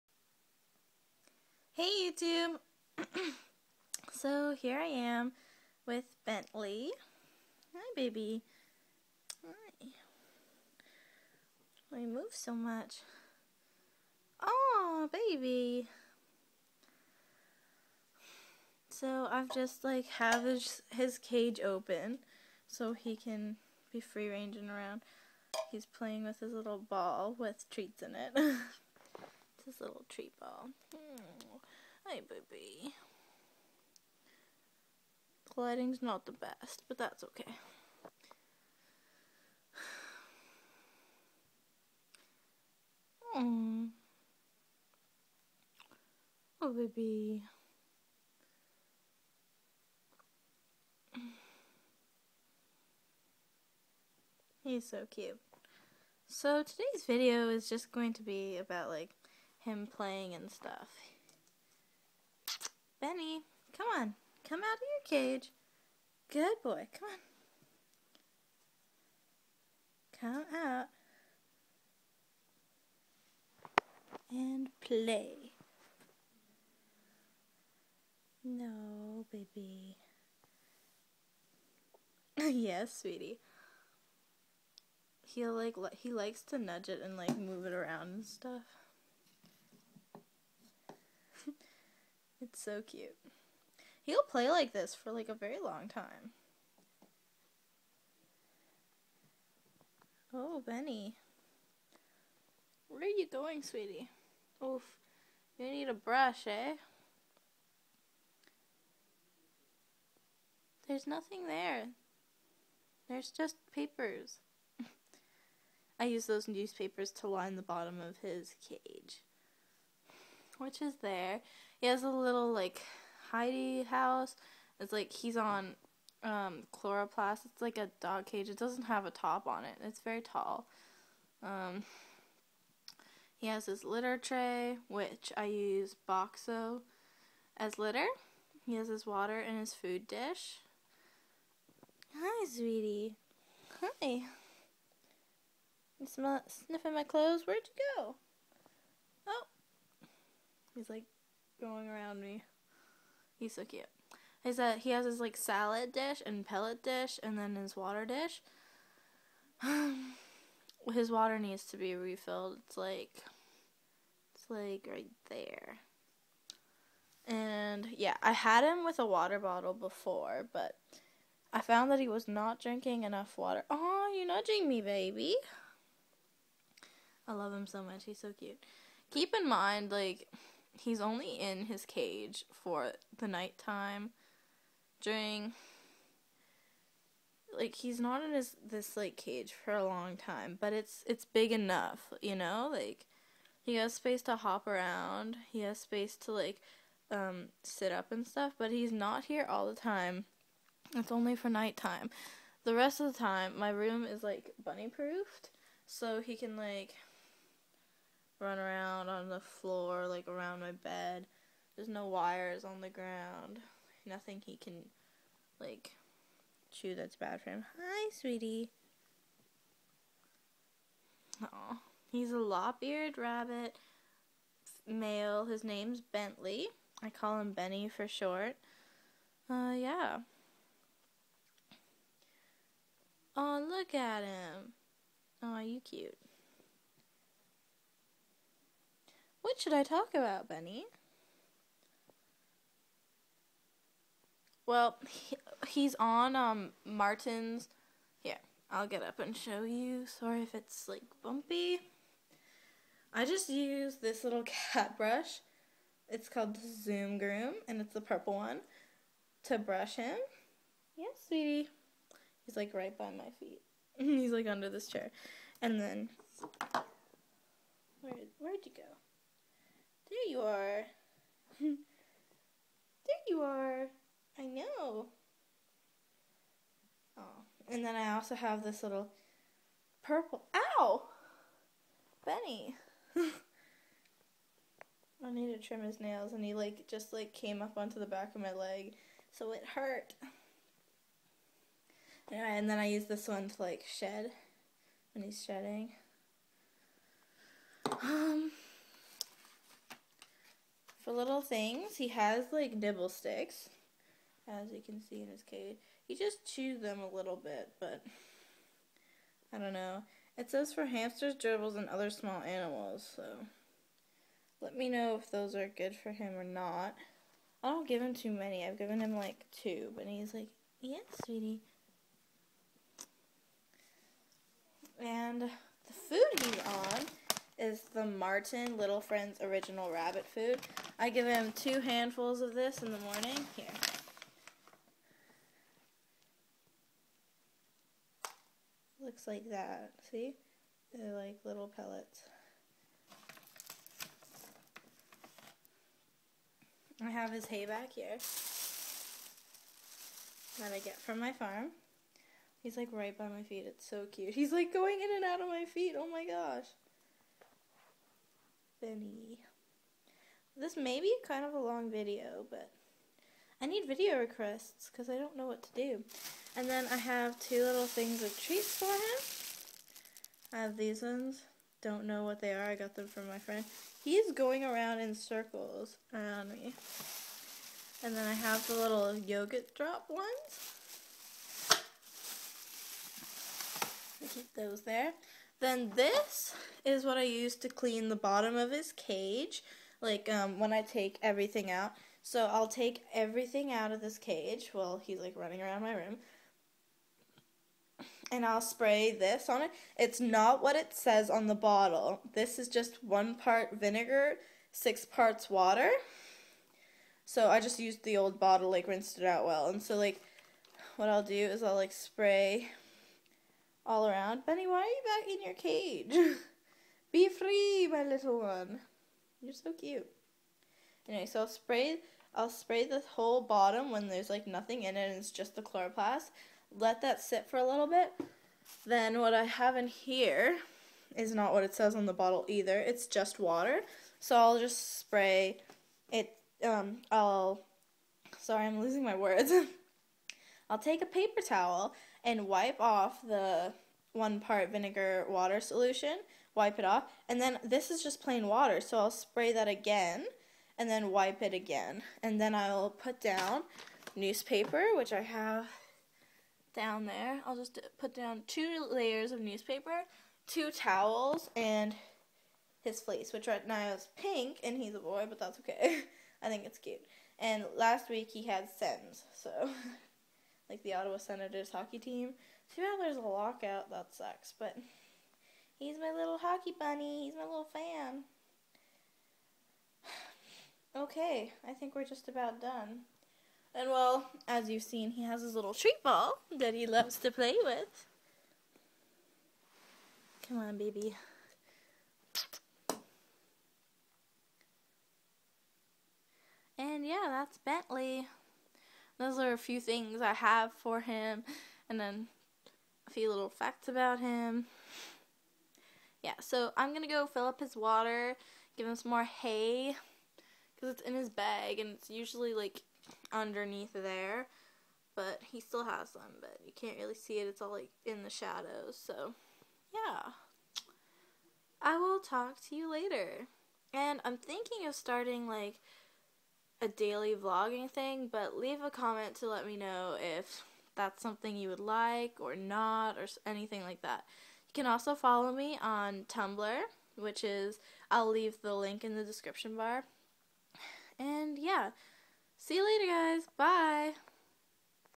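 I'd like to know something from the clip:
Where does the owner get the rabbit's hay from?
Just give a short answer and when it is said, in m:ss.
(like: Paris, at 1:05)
My farm, at 5:51.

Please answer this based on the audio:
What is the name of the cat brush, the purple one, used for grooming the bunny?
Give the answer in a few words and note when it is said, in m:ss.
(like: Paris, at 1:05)
Zoom Groom, at 4:16.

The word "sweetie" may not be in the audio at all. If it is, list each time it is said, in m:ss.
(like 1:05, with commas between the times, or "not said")
1:23, 1:43, 2:22, 3:38, 4:21, 5:21.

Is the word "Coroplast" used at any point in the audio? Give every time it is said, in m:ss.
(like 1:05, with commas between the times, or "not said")
2:06, 7:05.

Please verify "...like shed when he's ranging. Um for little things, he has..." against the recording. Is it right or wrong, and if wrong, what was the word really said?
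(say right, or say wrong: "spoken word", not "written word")
wrong: "shedding", not "ranging".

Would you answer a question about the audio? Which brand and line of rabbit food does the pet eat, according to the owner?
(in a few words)
Martin Little Friends.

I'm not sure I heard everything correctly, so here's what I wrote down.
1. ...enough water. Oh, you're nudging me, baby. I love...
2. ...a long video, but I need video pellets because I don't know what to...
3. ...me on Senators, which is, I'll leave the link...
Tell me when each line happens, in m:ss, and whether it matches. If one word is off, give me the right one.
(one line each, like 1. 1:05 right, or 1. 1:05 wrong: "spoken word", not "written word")
1. 2:53 right
2. 6:01 wrong: "requests", not "pellets"
3. 8:55 wrong: "Tumblr", not "Senators".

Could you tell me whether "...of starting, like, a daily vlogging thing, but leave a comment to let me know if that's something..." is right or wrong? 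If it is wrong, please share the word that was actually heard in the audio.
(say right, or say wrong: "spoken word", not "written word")
right.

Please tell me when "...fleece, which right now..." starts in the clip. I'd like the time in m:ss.
7:42.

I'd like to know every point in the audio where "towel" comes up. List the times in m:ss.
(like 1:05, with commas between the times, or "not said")
7:21, 7:40.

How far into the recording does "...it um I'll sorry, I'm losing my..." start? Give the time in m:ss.
7:16.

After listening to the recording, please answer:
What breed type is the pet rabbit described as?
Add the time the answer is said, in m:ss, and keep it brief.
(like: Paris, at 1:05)
Lop-eared, at 3:42.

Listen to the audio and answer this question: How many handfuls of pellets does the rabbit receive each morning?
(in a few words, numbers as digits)
2.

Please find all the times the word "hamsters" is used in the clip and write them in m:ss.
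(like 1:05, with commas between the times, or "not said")
5:10.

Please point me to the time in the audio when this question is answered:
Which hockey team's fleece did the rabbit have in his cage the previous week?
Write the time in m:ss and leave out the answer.
7:50.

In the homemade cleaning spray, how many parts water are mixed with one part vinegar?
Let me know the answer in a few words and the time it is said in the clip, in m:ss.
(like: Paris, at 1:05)
6, at 6:44.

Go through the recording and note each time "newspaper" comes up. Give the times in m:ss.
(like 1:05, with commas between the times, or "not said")
1:56, 7:34, 7:39.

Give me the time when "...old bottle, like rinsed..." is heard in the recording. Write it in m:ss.
6:48.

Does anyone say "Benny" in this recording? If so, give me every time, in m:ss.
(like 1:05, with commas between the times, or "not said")
1:03, 1:40, 3:47, 4:00, 4:42, 5:58, 6:54.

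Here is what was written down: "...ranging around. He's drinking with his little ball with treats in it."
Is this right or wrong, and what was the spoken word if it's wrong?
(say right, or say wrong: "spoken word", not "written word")
wrong: "playing", not "drinking".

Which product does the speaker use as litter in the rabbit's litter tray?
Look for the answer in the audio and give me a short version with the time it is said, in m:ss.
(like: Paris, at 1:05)
Boxo, at 2:16.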